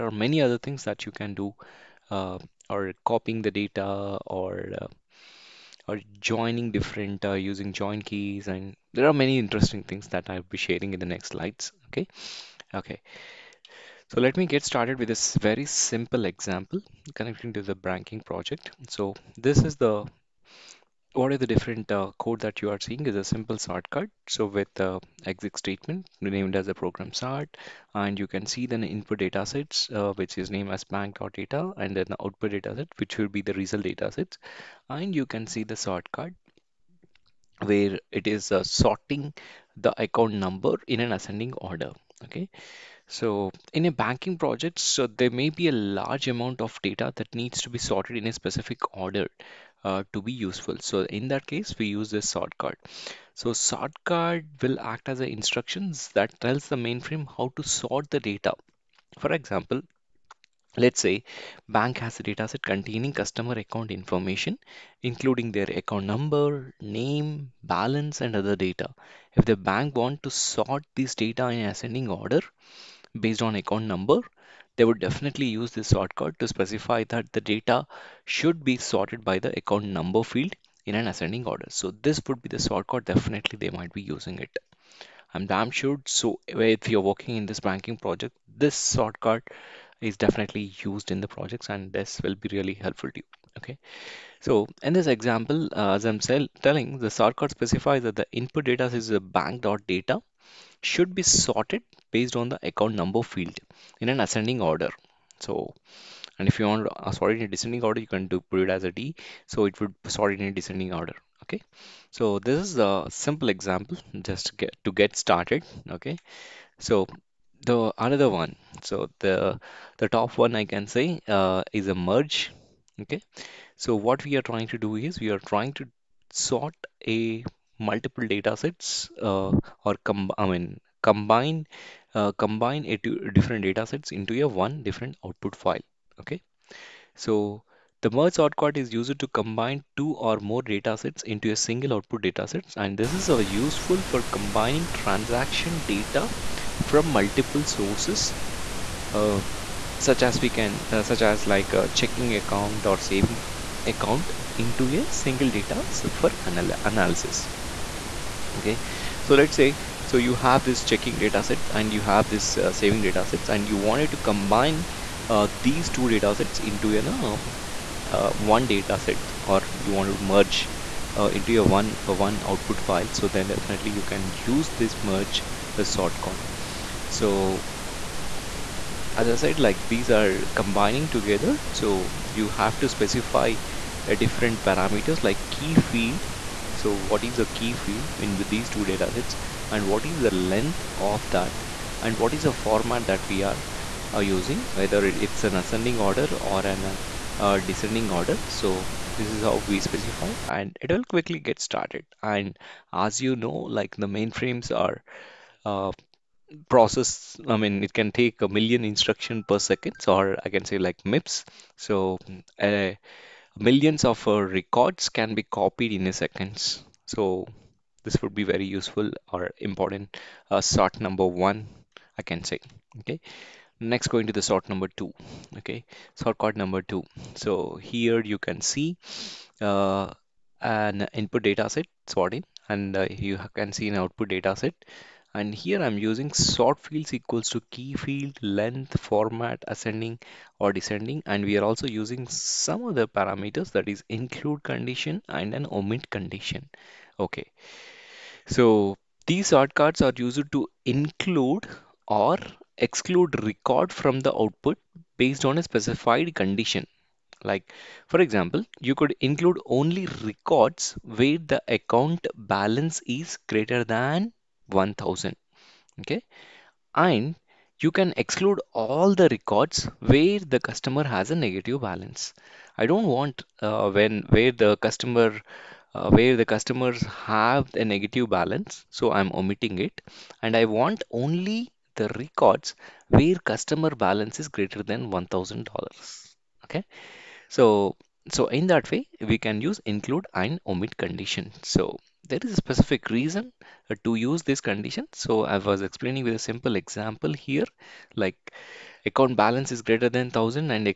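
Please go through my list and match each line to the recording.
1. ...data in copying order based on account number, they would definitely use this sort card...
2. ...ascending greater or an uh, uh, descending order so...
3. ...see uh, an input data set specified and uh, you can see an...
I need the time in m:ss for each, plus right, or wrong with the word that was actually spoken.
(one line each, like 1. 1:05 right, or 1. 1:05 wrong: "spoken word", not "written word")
1. 1:11 wrong: "ascending", not "copying"
2. 3:15 wrong: "order", not "greater"
3. 3:48 wrong: "sorted", not "specified".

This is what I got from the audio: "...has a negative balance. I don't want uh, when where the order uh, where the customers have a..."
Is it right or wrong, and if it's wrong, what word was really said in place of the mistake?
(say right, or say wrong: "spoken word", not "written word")
wrong: "customer", not "order".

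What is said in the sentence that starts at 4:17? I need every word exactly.
Like, for example, you could include only records where the account balance is greater than 1000.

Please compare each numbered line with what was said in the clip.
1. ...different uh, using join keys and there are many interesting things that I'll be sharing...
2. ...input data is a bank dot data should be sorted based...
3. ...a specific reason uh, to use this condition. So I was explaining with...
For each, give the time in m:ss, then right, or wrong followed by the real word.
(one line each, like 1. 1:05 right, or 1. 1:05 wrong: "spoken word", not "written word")
1. 0:06 right
2. 1:38 right
3. 4:52 right.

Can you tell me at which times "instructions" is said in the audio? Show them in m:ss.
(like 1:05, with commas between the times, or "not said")
0:55, 3:28.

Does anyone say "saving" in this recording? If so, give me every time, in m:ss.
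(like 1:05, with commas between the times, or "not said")
2:32, 2:42.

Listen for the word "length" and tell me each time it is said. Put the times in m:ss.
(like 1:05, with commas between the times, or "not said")
3:10, 3:58.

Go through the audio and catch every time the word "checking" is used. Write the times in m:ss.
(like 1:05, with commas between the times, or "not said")
2:31, 2:40.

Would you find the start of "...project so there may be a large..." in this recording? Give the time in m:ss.
0:44.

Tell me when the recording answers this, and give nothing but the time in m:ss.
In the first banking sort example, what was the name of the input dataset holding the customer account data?
0:30.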